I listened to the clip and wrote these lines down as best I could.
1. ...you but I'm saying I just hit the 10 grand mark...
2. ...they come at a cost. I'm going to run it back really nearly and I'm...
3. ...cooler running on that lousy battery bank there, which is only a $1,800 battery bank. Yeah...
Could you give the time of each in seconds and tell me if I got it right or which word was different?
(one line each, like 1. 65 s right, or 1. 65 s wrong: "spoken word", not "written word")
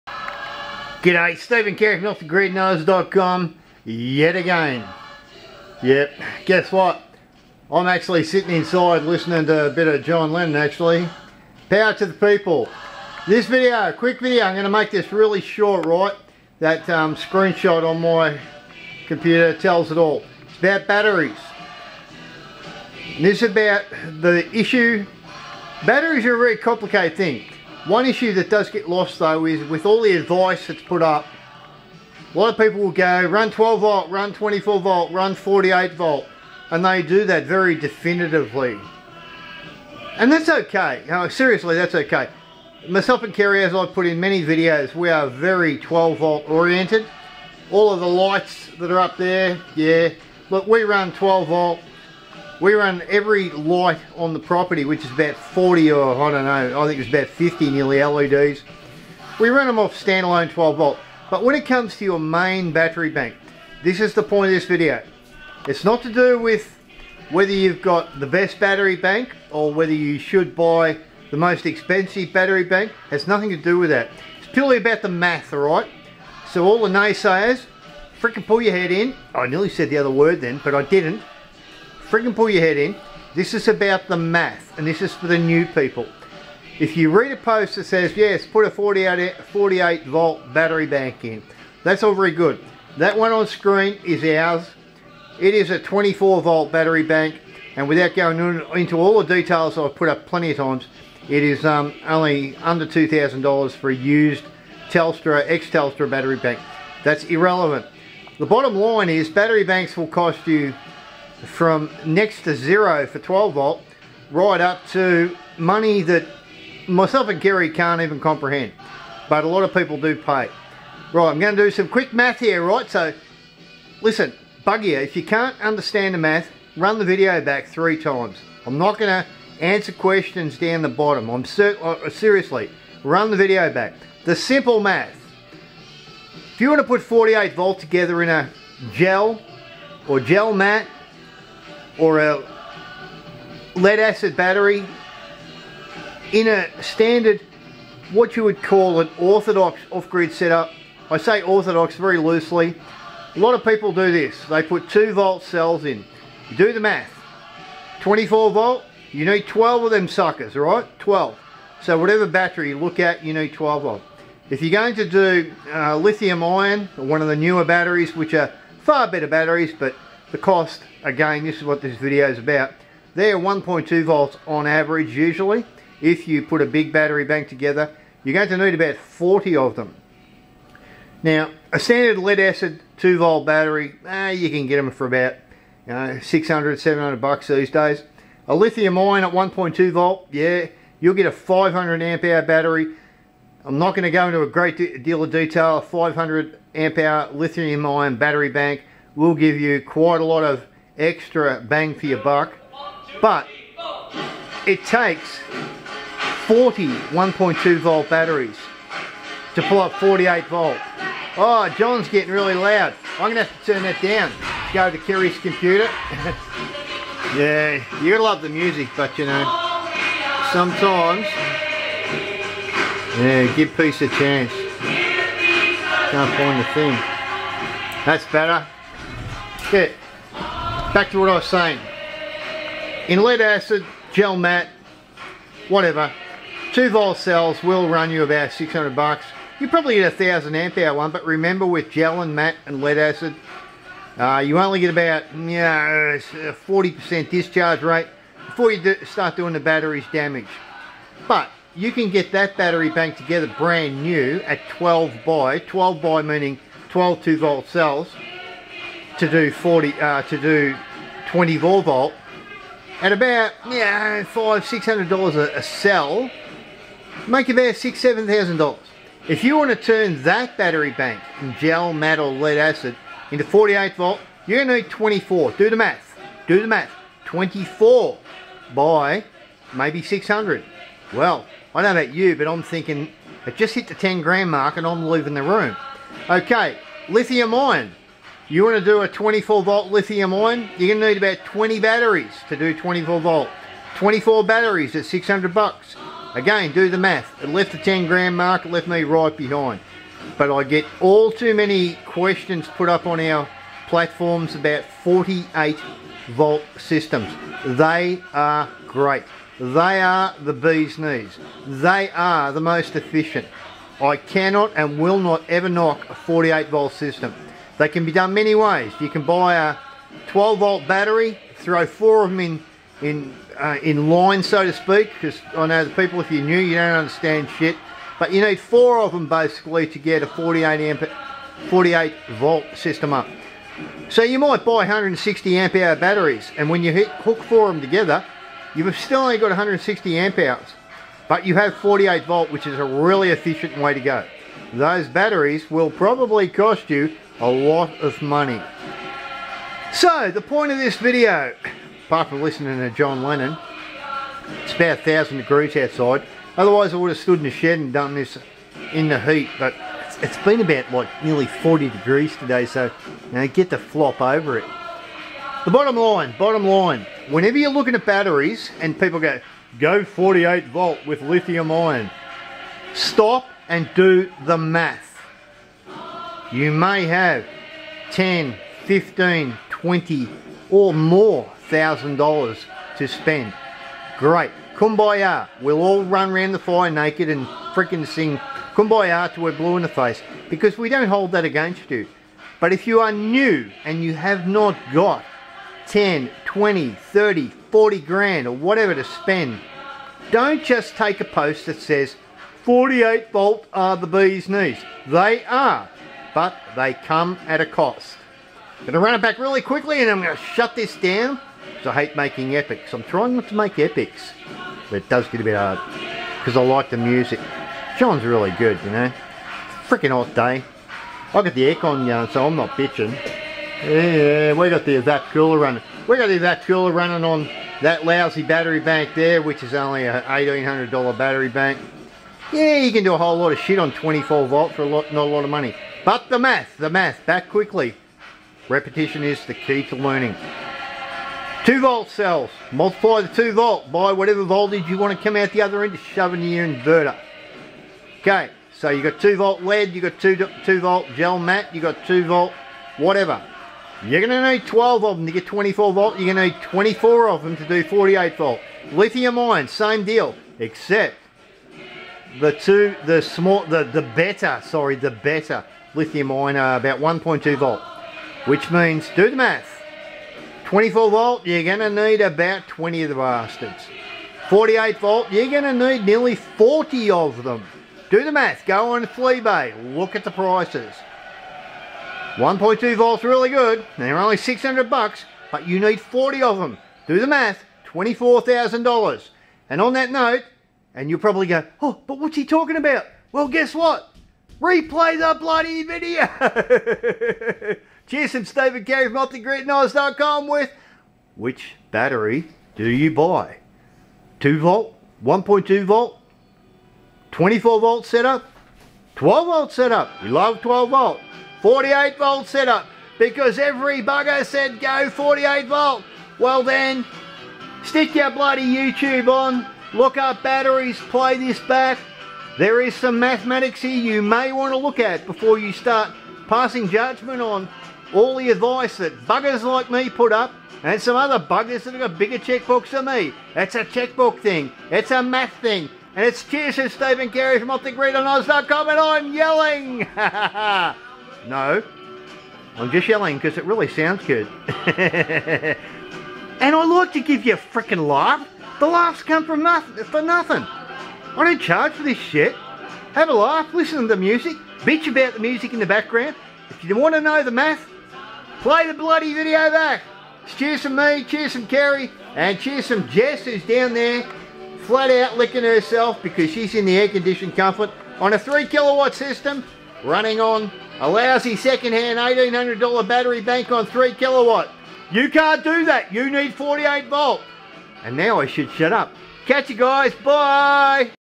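1. 282 s wrong: "thinking", not "saying"
2. 406 s wrong: "quickly", not "nearly"
3. 426 s right.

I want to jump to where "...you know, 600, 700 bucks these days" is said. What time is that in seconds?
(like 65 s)
185 s.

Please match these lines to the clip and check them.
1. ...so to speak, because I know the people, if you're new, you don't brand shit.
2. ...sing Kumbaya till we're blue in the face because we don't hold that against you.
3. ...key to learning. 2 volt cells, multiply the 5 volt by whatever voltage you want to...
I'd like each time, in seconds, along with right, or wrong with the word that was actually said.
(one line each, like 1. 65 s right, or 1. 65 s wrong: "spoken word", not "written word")
1. 324 s wrong: "understand", not "brand"
2. 388 s right
3. 439 s wrong: "2", not "5".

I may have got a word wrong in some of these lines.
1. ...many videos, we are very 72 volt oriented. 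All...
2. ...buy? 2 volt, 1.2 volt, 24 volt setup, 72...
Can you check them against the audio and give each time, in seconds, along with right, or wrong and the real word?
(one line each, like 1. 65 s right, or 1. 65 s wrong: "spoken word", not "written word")
1. 44 s wrong: "12", not "72"
2. 503 s wrong: "12", not "72".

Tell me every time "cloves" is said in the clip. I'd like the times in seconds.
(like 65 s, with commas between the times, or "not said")
not said.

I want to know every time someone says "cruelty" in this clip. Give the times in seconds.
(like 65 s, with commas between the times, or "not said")
not said.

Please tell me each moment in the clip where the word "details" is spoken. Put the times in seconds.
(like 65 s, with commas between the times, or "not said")
99 s, 195 s.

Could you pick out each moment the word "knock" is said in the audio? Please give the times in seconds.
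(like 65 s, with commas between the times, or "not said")
315 s.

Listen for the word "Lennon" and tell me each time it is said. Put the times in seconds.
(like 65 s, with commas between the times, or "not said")
10 s, 353 s.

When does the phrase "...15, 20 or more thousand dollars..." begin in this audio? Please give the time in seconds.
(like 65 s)
378 s.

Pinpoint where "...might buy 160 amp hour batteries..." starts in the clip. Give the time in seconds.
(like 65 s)
334 s.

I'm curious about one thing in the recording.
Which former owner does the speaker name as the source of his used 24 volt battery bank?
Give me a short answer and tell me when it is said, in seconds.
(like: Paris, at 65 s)
Telstra, at 105 s.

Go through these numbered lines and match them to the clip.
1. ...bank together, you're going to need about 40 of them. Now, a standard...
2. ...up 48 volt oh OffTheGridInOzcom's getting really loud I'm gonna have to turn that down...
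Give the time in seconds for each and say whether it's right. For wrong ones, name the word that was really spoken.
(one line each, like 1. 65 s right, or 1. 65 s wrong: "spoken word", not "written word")
1. 177 s right
2. 209 s wrong: "John", not "OffTheGridInOzcom".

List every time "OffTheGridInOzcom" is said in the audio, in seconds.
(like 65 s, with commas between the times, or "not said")
2 s, 499 s, 537 s.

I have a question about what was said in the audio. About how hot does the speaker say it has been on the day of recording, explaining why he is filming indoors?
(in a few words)
40 degrees.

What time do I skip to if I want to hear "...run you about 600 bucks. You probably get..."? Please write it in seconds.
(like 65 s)
237 s.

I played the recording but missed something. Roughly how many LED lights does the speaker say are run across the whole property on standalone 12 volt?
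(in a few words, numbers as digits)
50.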